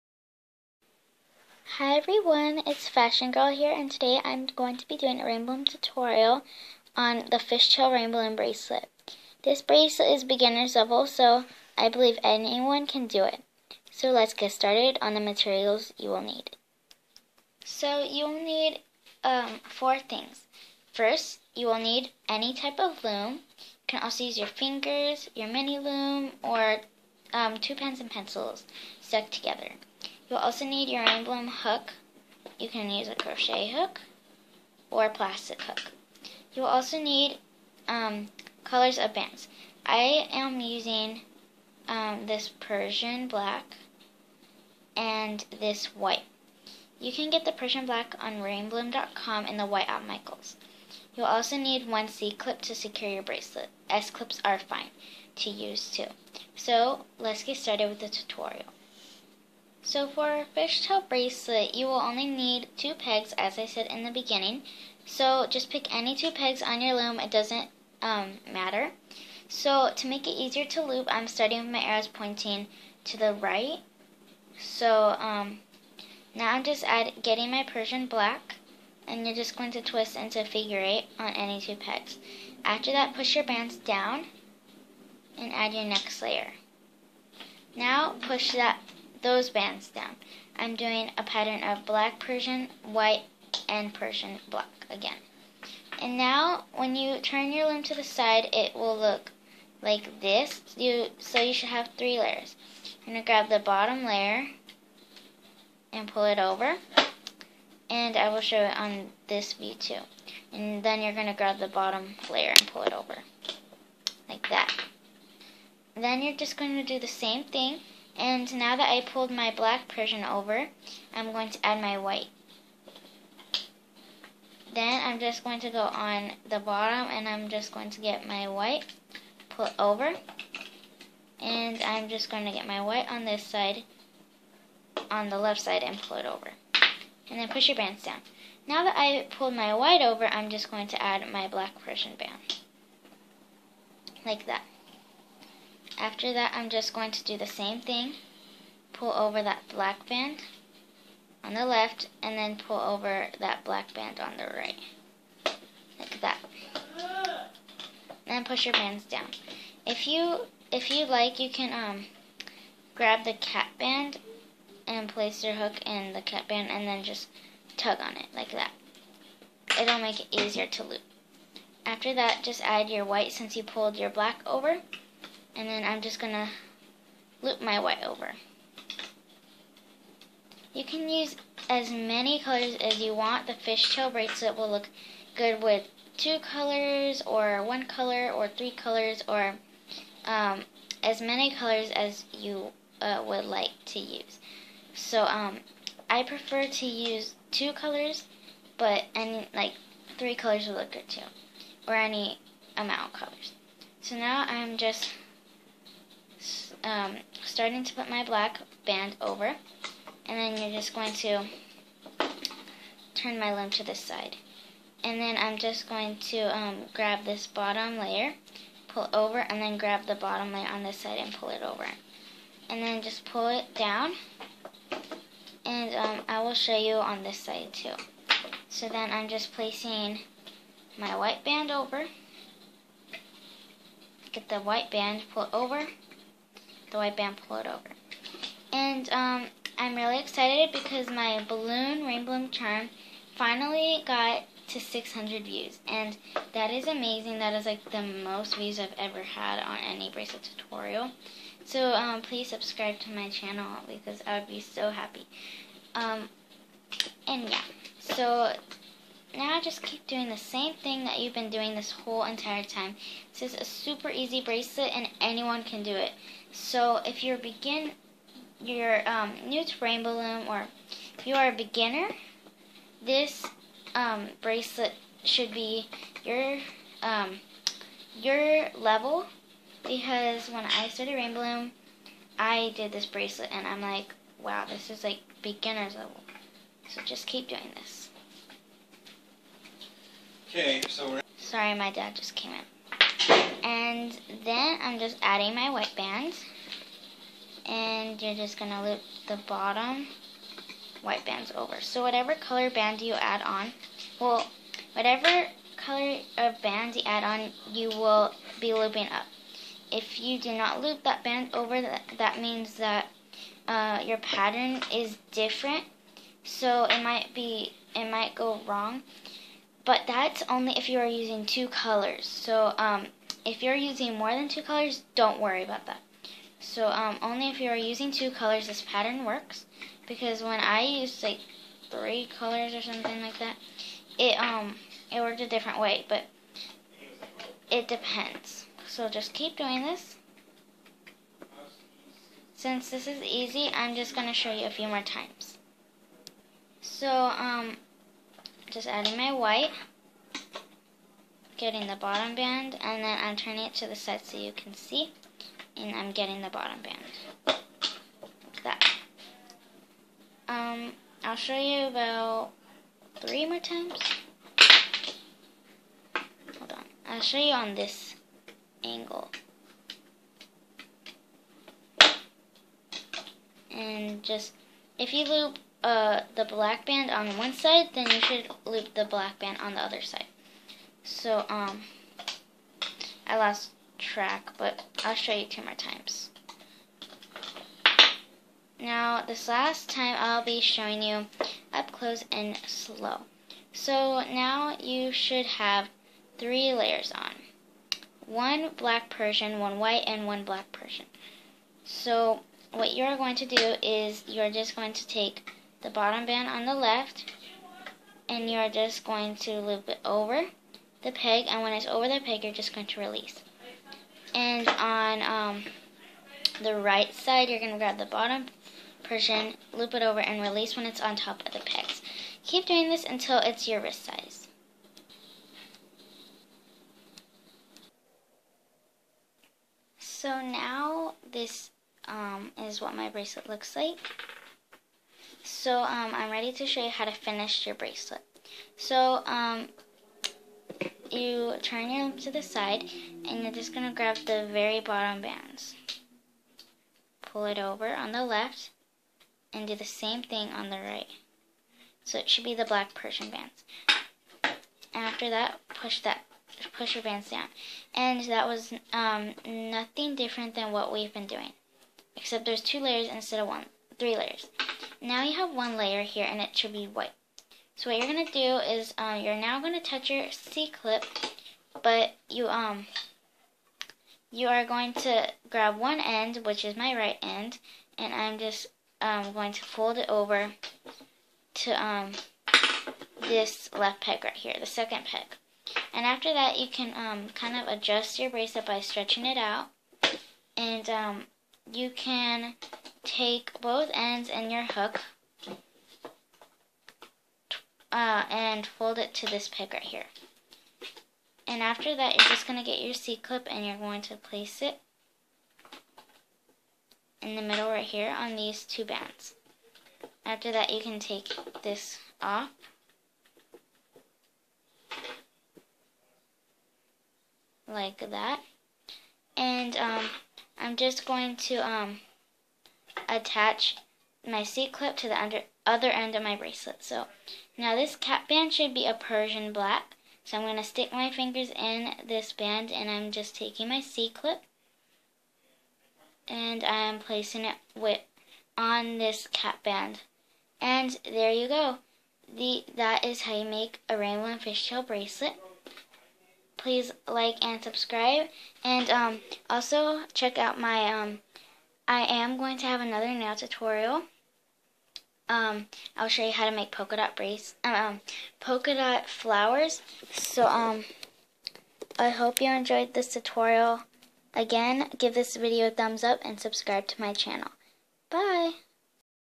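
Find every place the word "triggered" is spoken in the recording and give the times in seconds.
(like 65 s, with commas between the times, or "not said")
not said.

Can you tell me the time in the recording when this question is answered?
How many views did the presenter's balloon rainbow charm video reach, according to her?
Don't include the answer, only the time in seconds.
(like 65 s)
244 s.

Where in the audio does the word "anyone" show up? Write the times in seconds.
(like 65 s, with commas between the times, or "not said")
12 s, 265 s.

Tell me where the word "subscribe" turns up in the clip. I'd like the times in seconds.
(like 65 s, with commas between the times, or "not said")
252 s, 547 s, 566 s.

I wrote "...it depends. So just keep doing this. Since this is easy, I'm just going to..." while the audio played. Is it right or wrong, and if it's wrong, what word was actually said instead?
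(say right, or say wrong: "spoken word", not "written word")
right.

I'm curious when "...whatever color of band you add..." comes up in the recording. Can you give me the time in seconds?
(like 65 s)
304 s.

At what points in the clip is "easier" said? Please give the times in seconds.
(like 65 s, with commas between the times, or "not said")
70 s, 170 s.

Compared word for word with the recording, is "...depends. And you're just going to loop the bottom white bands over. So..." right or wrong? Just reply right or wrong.
wrong.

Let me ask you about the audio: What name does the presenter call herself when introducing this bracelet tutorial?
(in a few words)
Fashion Girl.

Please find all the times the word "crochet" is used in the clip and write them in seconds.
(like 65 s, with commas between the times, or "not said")
33 s.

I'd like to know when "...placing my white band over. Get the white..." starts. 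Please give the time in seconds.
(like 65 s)
229 s.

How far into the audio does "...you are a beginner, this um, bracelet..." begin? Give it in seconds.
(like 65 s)
271 s.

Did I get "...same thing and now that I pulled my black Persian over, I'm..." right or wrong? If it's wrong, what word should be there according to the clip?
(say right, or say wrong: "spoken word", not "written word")
right.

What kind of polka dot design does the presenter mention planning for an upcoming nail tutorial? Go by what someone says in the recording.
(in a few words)
Polka dot flowers.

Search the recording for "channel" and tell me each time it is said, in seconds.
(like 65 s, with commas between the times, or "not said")
253 s, 567 s.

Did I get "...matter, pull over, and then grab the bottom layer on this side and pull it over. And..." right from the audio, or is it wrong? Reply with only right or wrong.
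wrong.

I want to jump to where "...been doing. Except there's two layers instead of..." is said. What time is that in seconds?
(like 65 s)
461 s.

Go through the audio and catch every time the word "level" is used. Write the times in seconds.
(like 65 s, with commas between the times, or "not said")
10 s, 278 s, 285 s.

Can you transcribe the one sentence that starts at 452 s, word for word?
So it should be the black Persian bands.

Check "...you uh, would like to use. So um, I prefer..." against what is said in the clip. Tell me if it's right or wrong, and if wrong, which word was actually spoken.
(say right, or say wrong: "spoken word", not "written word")
right.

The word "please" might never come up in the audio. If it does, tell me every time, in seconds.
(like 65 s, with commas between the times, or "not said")
252 s, 546 s.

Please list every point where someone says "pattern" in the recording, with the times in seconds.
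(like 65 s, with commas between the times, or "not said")
91 s, 314 s, 328 s.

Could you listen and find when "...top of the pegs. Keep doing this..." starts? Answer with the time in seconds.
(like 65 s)
421 s.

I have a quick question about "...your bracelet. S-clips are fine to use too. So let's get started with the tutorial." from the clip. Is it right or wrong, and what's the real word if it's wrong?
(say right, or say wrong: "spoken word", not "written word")
right.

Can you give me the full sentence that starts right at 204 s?
So now I'm just um, starting to put my black band over.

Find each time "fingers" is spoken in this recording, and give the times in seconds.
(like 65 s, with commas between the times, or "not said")
24 s, 531 s.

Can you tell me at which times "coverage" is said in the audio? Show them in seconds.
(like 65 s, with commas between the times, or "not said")
not said.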